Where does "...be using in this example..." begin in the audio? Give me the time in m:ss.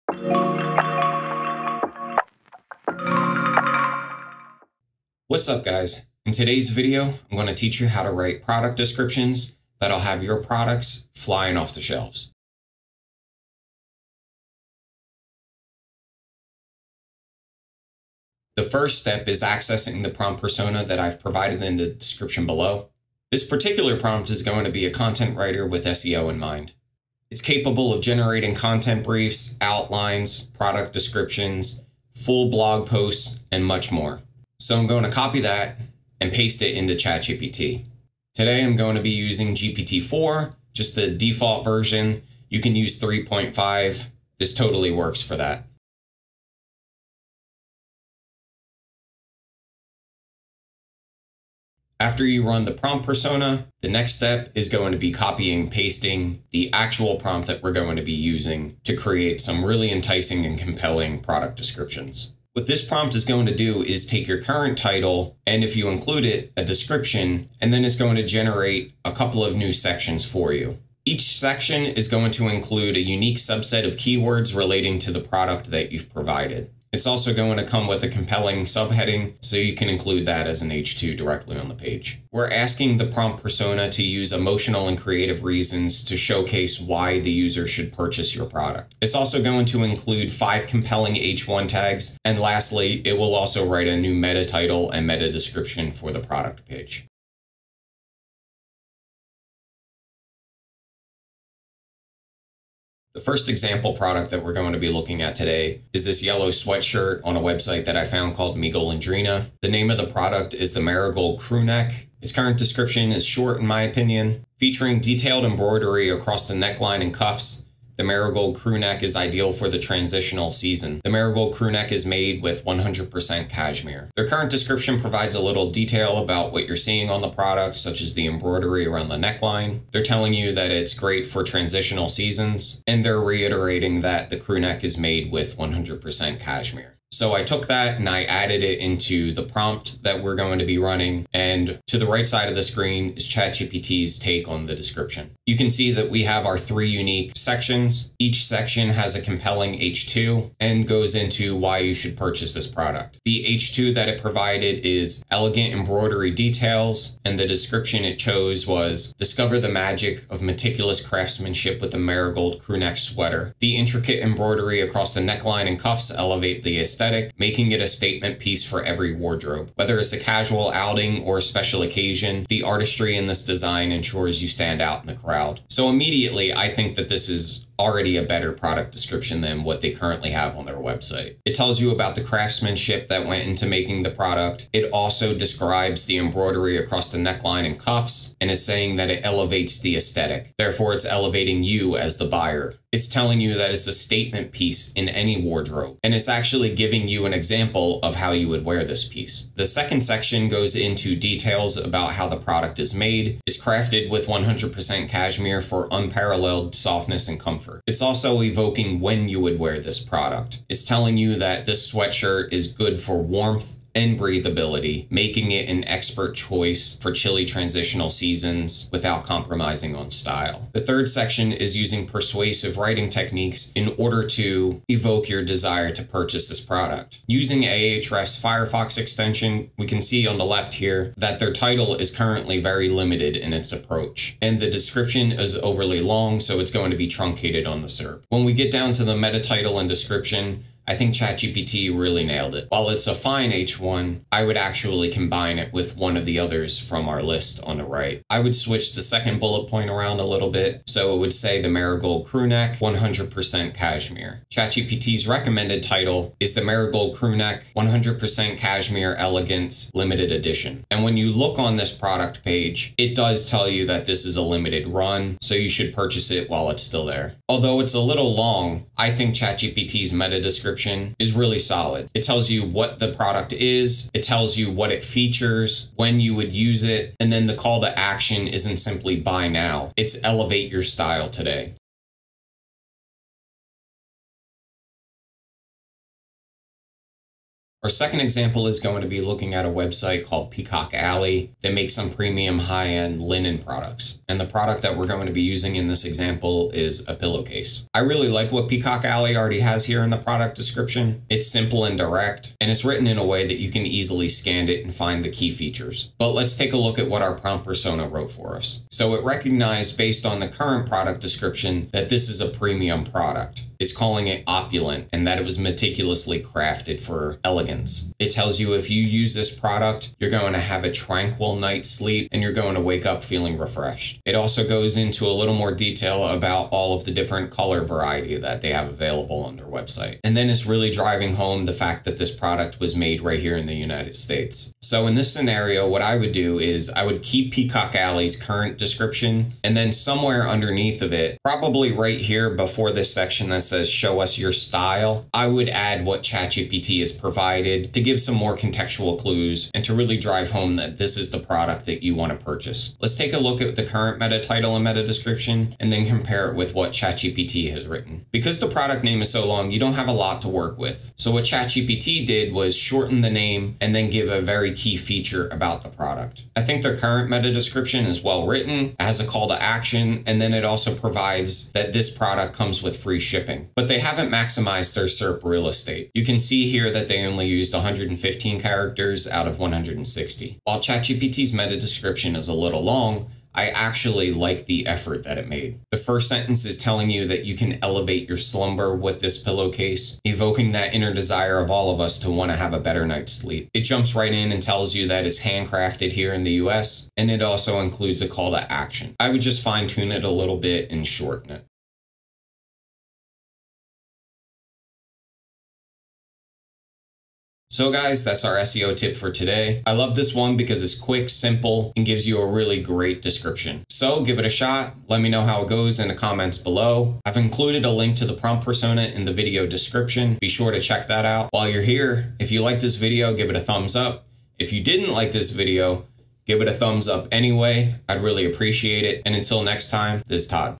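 4:55.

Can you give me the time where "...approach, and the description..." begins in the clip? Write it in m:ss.
3:53.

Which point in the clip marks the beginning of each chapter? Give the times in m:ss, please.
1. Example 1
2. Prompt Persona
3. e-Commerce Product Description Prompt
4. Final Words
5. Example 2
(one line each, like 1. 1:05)
1. 1:37
2. 0:12
3. 0:45
4. 6:41
5. 4:41.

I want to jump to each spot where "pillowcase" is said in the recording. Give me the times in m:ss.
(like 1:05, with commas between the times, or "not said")
4:57, 6:29.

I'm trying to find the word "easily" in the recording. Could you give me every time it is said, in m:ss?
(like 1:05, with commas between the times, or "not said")
5:03.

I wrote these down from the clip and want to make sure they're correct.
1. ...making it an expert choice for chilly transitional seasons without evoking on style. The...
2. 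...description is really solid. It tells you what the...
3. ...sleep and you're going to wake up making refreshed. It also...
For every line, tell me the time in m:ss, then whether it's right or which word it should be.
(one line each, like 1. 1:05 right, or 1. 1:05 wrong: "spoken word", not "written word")
1. 3:35 wrong: "compromising", not "evoking"
2. 4:30 right
3. 5:21 wrong: "feeling", not "making".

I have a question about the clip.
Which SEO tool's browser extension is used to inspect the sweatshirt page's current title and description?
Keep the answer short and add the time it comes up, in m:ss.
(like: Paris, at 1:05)
Ahrefs, at 3:47.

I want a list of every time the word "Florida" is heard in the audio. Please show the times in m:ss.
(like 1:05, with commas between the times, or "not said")
not said.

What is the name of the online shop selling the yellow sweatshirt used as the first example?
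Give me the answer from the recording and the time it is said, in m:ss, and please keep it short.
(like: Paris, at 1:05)
Mi Golondrina, at 1:48.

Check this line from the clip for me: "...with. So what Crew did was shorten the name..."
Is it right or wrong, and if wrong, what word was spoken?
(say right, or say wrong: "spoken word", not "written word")
wrong: "ChatGPT", not "Crew".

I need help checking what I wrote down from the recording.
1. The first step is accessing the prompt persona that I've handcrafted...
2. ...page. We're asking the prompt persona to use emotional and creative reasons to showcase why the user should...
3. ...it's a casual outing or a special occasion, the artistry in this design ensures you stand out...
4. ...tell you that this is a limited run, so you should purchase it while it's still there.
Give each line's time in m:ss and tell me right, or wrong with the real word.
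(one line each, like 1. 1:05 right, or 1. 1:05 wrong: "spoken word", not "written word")
1. 0:18 wrong: "provided", not "handcrafted"
2. 1:21 right
3. 2:49 right
4. 4:23 right.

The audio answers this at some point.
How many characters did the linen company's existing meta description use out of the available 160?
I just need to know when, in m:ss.
6:17.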